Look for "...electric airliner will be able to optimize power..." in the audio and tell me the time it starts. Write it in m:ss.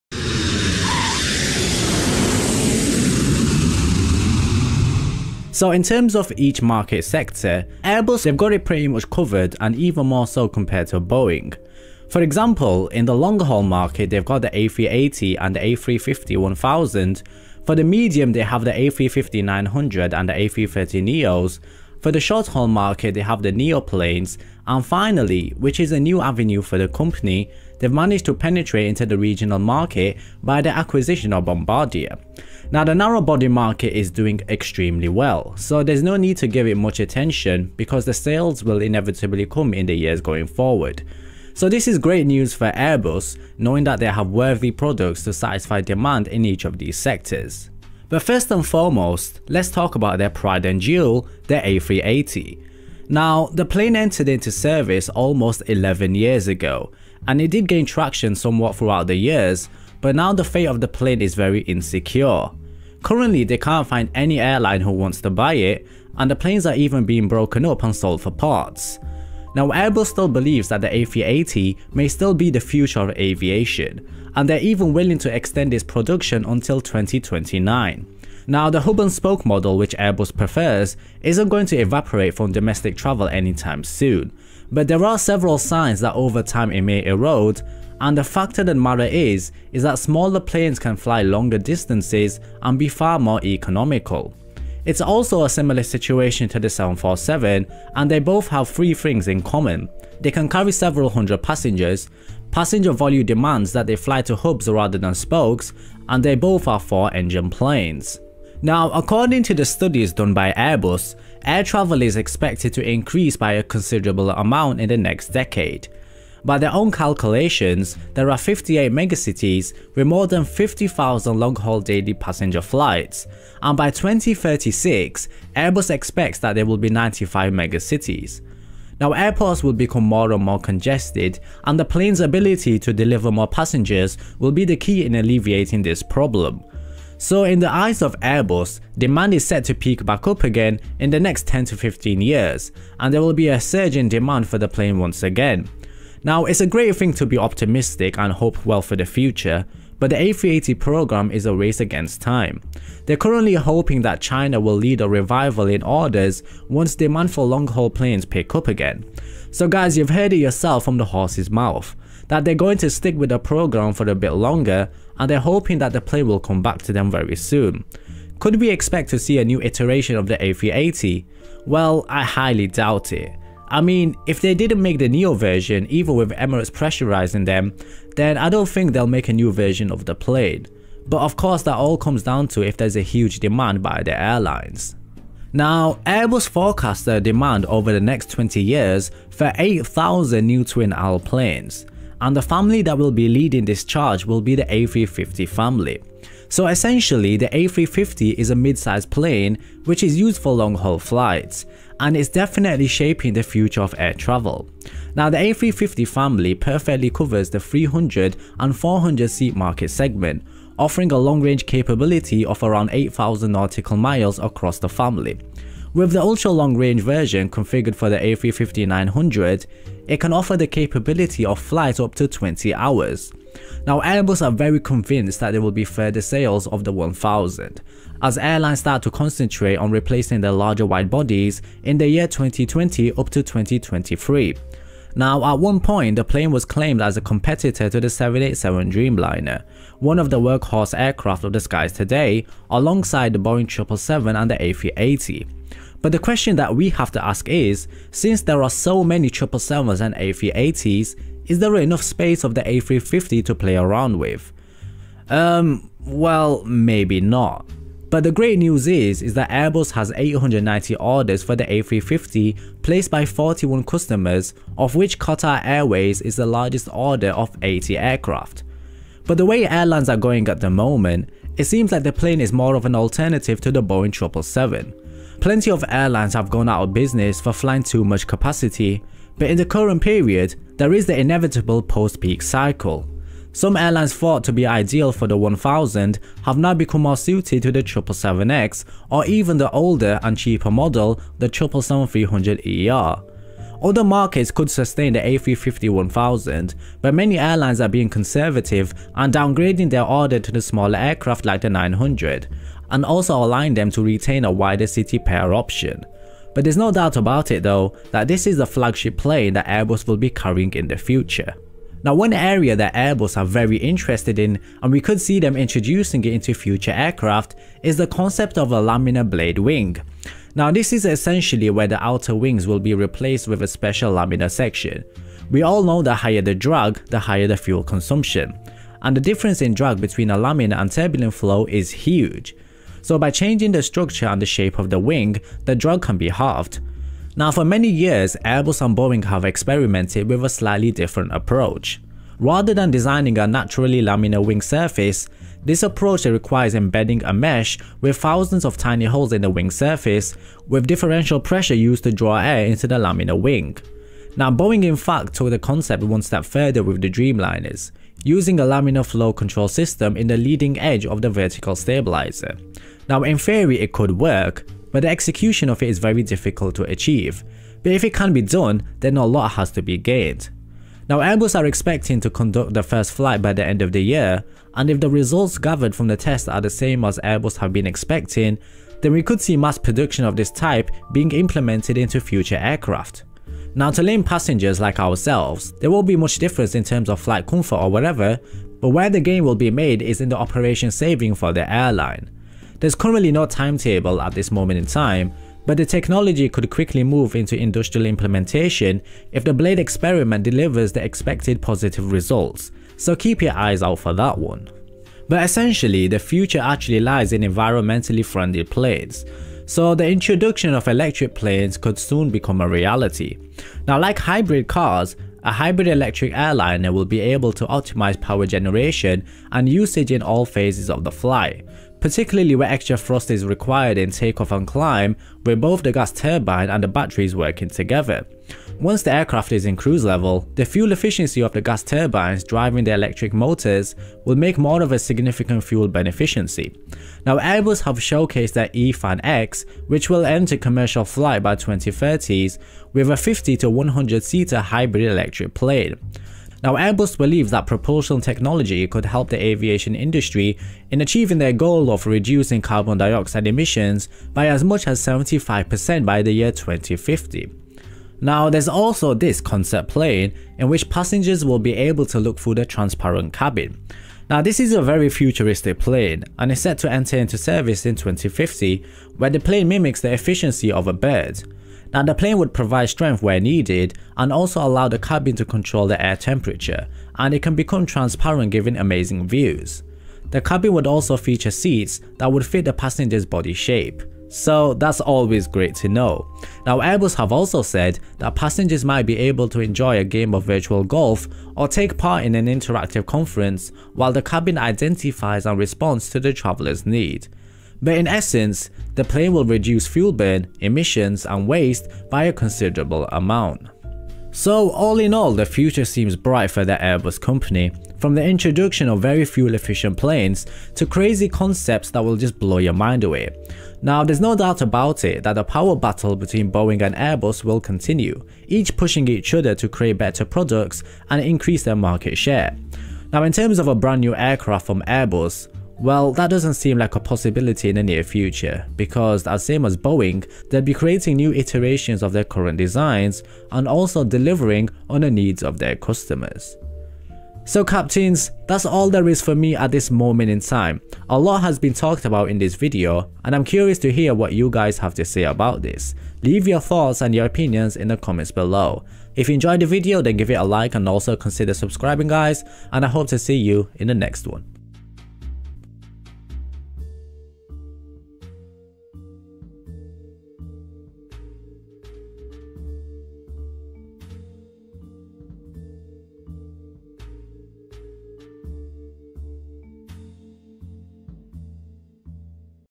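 6:55.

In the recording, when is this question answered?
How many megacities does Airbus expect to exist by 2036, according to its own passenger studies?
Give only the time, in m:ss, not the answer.
2:06.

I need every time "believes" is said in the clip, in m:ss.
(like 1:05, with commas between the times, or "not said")
1:10, 7:27.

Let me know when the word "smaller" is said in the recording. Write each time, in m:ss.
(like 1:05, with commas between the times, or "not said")
1:29, 5:00.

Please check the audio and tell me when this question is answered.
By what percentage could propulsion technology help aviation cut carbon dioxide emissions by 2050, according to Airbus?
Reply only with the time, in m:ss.
7:35.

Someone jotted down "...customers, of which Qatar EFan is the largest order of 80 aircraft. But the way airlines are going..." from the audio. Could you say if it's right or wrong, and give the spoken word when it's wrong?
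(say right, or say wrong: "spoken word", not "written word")
wrong: "Airways", not "EFan".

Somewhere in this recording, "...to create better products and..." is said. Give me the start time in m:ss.
8:39.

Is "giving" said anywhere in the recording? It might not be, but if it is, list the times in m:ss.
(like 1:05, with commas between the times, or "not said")
7:58.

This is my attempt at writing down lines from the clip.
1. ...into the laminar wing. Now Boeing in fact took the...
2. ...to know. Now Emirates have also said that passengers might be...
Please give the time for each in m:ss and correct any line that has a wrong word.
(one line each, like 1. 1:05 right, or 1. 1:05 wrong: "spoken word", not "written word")
1. 5:52 right
2. 8:05 wrong: "Airbus", not "Emirates".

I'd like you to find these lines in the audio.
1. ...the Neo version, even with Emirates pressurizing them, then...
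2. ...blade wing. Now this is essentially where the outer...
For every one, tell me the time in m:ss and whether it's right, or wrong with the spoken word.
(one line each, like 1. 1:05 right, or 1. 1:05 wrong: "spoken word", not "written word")
1. 2:54 right
2. 5:19 right.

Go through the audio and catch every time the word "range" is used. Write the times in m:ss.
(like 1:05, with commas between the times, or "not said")
3:31, 3:36.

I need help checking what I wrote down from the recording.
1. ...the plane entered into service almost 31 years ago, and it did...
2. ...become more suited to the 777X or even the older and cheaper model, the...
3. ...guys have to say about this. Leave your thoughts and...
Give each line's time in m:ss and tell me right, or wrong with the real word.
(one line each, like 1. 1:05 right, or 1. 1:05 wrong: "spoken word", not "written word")
1. 0:53 wrong: "11", not "31"
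2. 4:46 right
3. 9:04 right.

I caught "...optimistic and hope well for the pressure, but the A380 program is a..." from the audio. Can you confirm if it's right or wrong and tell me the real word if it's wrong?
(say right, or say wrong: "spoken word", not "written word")
wrong: "future", not "pressure".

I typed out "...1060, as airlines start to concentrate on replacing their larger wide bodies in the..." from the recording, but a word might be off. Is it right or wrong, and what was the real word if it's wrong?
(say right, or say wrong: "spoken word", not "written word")
wrong: "1000", not "1060".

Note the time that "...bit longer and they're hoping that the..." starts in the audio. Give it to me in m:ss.
2:44.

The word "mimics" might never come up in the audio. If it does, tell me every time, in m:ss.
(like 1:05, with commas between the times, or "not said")
7:49.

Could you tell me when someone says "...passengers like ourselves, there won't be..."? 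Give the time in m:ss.
6:24.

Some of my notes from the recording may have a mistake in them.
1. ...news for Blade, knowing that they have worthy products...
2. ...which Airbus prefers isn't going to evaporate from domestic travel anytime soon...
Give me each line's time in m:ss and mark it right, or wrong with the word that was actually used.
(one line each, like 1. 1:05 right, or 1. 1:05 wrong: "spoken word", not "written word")
1. 0:42 wrong: "Airbus", not "Blade"
2. 1:19 right.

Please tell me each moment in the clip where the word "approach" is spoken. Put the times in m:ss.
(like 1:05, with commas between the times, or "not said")
5:41, 5:45.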